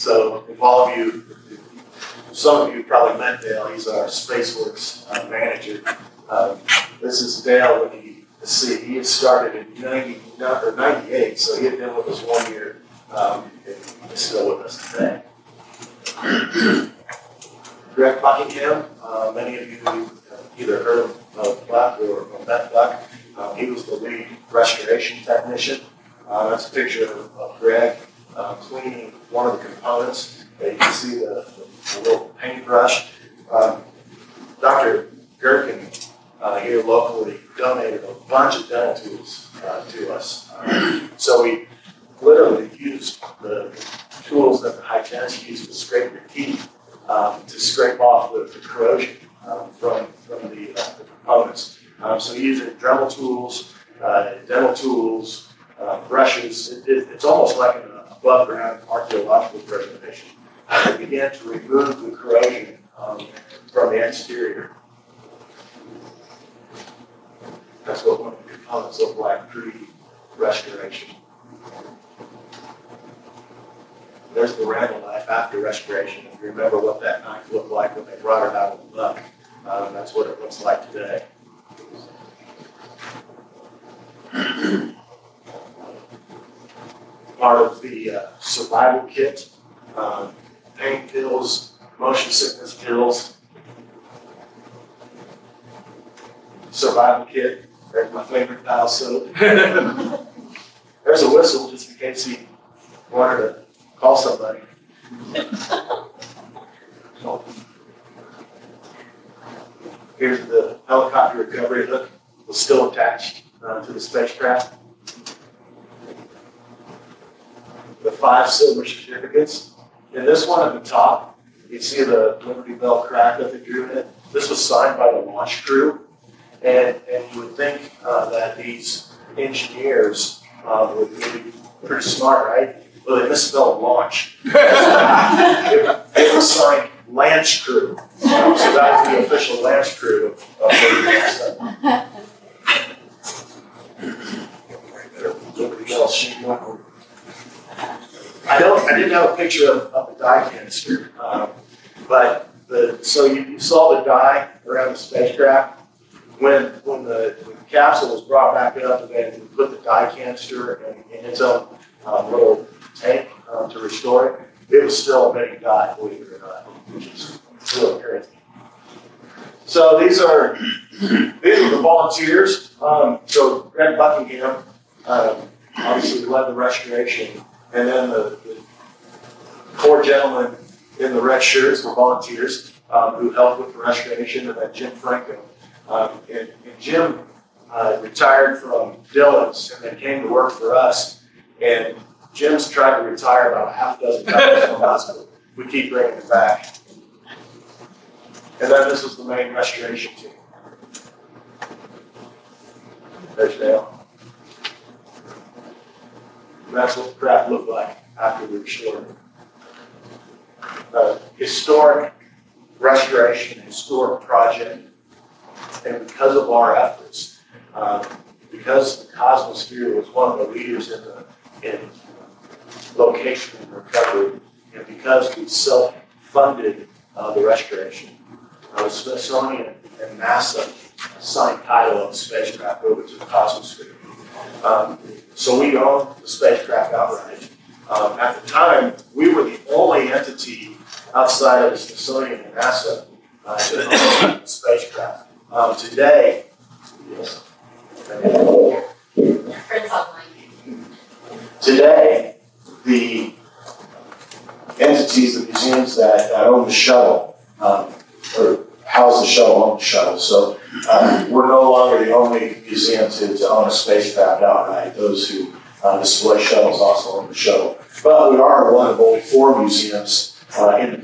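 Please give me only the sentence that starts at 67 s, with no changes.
That's what one of the components look like pre-restoration.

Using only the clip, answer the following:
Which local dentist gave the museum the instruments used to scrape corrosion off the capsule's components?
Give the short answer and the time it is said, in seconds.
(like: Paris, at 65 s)
Dr. Gherkin, at 34 s.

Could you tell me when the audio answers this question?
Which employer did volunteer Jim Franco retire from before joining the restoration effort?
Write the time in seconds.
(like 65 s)
189 s.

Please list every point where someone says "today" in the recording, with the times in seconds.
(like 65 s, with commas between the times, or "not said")
14 s, 80 s, 245 s, 251 s.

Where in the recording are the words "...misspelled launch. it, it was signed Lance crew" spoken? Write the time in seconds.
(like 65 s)
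133 s.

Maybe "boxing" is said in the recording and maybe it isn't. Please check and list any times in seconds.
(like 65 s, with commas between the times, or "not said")
not said.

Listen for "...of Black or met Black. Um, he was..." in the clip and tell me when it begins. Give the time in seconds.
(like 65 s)
21 s.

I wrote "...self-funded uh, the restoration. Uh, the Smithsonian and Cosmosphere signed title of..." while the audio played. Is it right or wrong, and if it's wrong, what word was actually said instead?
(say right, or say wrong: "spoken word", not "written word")
wrong: "NASA", not "Cosmosphere".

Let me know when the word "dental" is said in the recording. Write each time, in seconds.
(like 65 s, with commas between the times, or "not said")
38 s, 54 s.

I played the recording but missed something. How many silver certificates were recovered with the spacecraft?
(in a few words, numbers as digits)
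5.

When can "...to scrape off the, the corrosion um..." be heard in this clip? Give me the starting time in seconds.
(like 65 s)
47 s.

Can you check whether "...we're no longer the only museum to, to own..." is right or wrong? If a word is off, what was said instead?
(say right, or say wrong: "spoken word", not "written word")
right.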